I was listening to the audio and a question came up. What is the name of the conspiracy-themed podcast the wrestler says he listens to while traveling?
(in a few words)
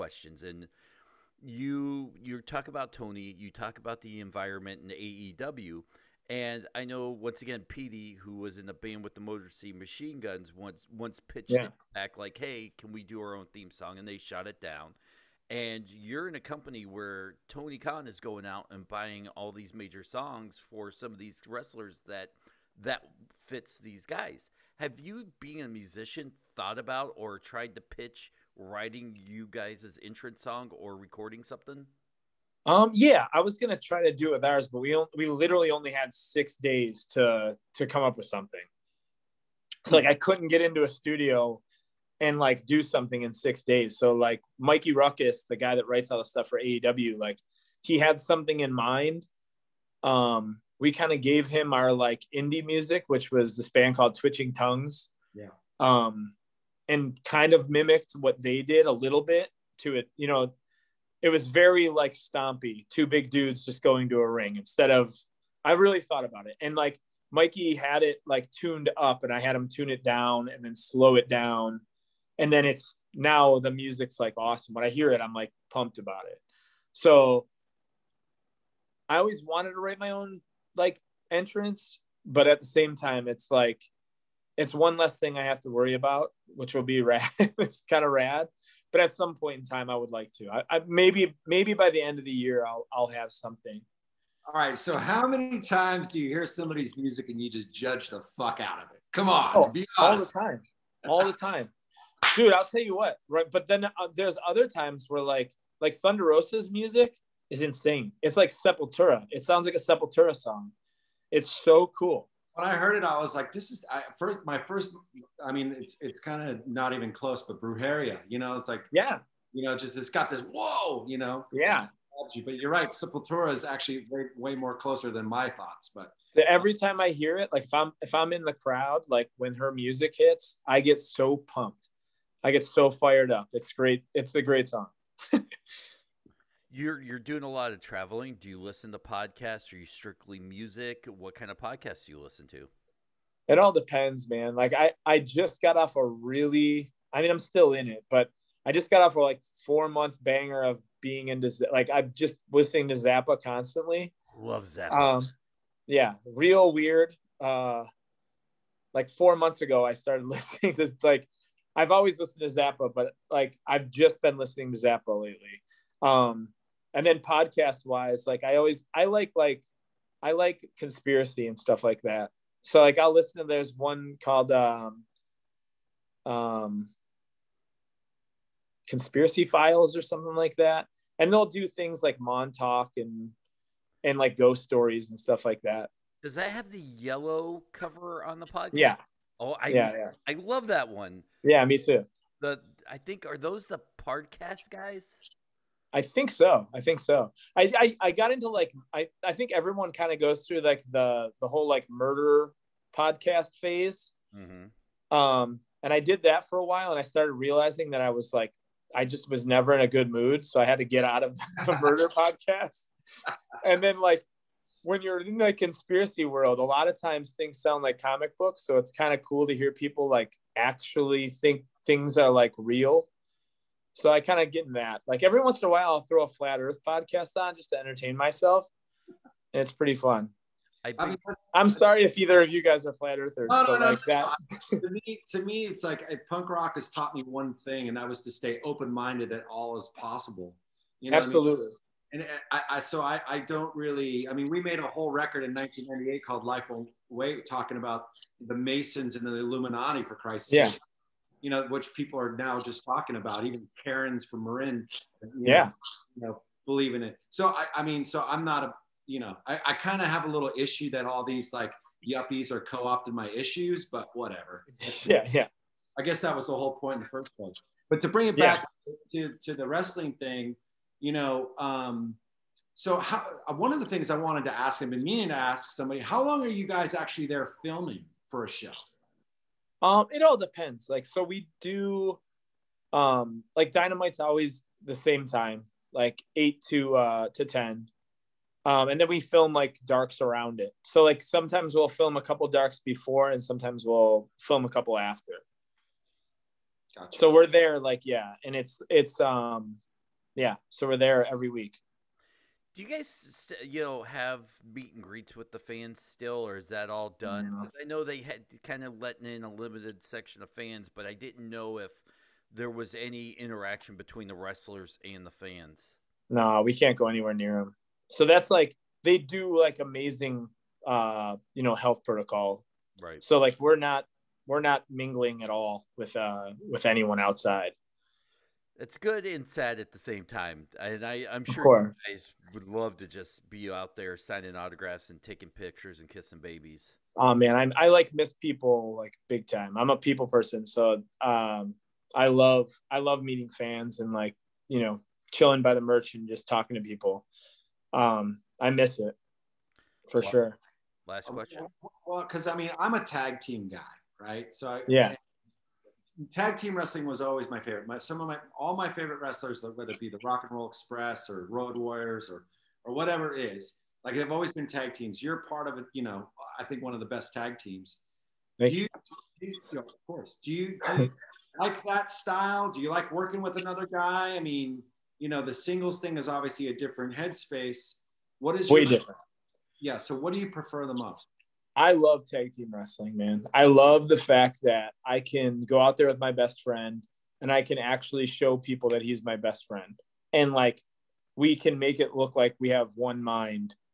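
Conspiracy Files.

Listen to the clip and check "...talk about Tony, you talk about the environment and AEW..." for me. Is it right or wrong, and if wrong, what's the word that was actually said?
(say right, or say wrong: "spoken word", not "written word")
right.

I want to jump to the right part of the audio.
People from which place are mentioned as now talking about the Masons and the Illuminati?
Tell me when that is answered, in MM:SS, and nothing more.
04:14.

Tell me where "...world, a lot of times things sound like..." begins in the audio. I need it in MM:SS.
03:36.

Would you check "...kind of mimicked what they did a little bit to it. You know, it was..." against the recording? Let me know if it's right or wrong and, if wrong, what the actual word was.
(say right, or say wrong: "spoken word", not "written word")
right.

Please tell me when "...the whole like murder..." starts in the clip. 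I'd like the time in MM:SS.
03:21.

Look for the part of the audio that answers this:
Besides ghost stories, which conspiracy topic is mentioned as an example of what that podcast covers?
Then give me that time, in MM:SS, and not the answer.
03:02.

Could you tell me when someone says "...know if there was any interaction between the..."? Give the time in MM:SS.
05:11.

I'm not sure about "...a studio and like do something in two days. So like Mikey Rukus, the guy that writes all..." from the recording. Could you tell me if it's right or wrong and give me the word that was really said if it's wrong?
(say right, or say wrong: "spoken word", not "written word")
wrong: "six", not "two".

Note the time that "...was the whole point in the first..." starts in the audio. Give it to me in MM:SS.
04:26.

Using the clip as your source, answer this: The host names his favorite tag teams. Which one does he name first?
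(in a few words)
Rock and Roll Express.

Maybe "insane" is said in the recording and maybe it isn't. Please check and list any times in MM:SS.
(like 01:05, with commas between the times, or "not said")
01:47.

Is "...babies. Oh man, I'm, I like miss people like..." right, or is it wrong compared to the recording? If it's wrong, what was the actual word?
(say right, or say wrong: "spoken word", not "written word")
right.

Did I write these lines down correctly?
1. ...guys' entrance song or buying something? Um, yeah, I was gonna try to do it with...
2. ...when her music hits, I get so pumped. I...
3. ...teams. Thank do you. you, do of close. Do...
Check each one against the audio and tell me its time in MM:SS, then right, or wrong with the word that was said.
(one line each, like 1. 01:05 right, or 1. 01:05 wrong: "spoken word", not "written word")
1. 00:29 wrong: "recording", not "buying"
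2. 02:09 right
3. 06:07 wrong: "course", not "close".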